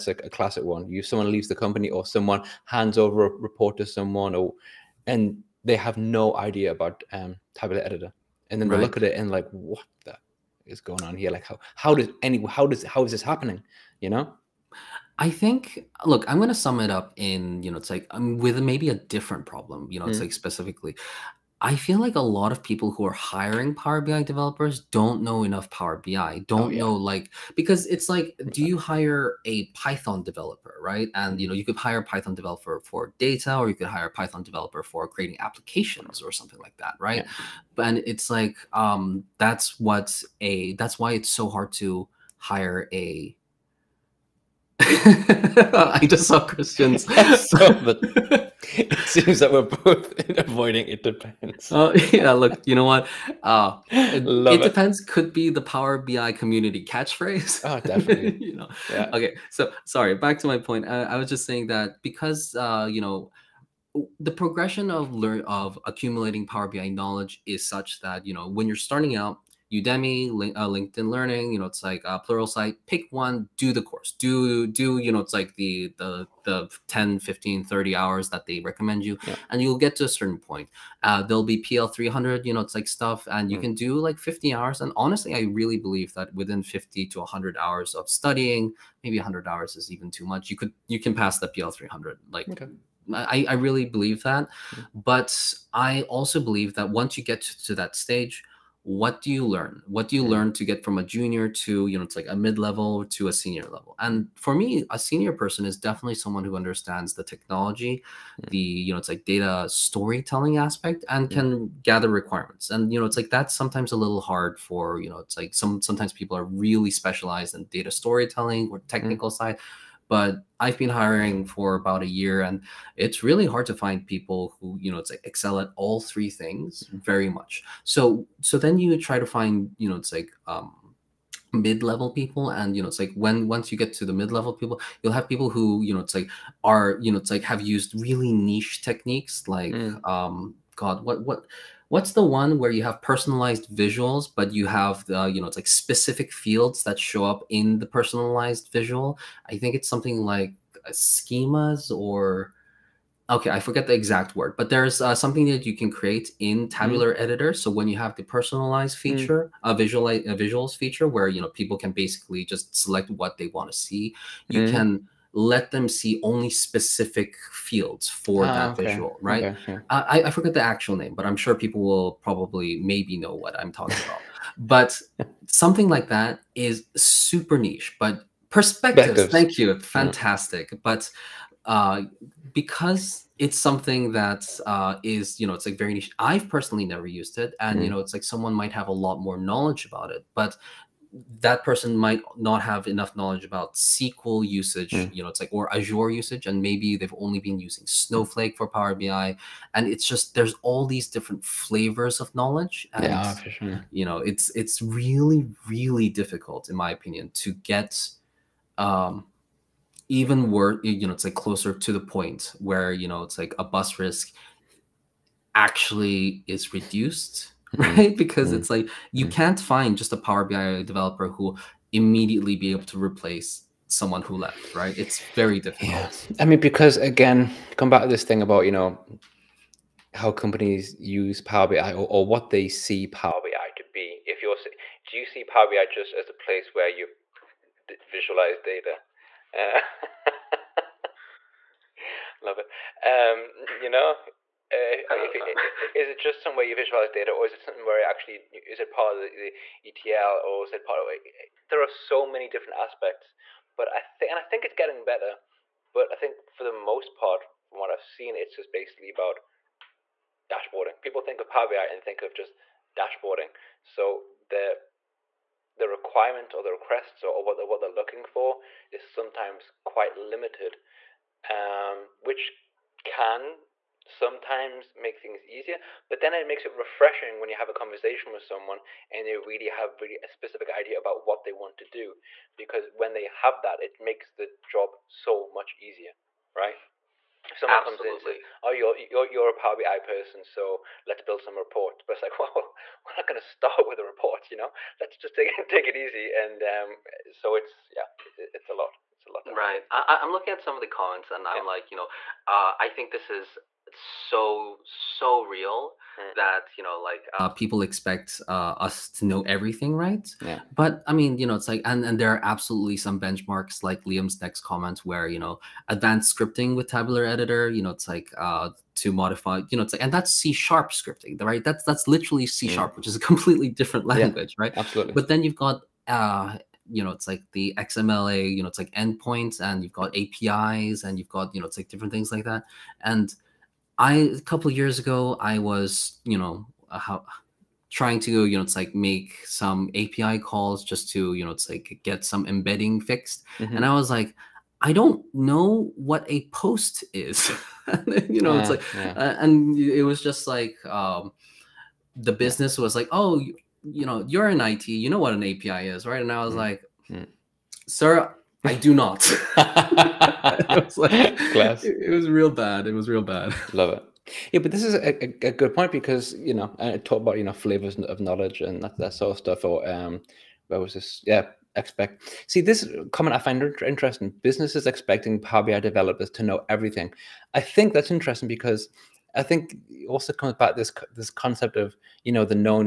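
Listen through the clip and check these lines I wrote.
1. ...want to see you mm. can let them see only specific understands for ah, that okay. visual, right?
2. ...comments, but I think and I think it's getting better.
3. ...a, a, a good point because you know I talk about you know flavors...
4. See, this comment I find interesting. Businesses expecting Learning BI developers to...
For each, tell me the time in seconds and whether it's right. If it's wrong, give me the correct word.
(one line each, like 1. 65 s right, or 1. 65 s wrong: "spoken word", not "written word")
1. 163 s wrong: "fields", not "understands"
2. 252 s wrong: "aspects", not "comments"
3. 364 s right
4. 372 s wrong: "Power", not "Learning".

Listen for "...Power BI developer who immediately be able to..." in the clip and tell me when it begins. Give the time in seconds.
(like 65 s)
220 s.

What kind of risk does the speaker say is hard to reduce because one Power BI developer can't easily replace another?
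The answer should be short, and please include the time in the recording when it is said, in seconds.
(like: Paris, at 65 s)
Bus risk, at 213 s.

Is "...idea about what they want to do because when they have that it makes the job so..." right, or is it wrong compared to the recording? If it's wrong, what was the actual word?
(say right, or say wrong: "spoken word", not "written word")
right.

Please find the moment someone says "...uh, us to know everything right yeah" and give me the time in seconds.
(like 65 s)
308 s.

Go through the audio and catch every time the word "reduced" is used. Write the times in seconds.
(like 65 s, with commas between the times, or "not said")
216 s.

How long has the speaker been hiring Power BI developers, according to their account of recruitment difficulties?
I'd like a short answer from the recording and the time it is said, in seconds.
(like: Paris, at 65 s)
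About a year, at 121 s.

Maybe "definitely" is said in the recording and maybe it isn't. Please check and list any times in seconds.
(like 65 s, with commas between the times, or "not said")
57 s, 105 s.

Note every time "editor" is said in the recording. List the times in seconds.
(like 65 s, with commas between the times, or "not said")
7 s, 157 s, 317 s.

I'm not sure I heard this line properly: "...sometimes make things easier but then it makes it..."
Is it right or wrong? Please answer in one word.
right.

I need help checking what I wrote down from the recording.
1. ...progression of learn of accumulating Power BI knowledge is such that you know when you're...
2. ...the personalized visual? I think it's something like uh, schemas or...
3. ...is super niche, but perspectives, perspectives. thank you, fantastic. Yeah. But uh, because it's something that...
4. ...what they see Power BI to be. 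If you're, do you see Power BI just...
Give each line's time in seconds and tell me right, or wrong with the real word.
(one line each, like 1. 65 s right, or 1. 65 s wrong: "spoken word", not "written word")
1. 64 s right
2. 147 s right
3. 176 s right
4. 232 s right.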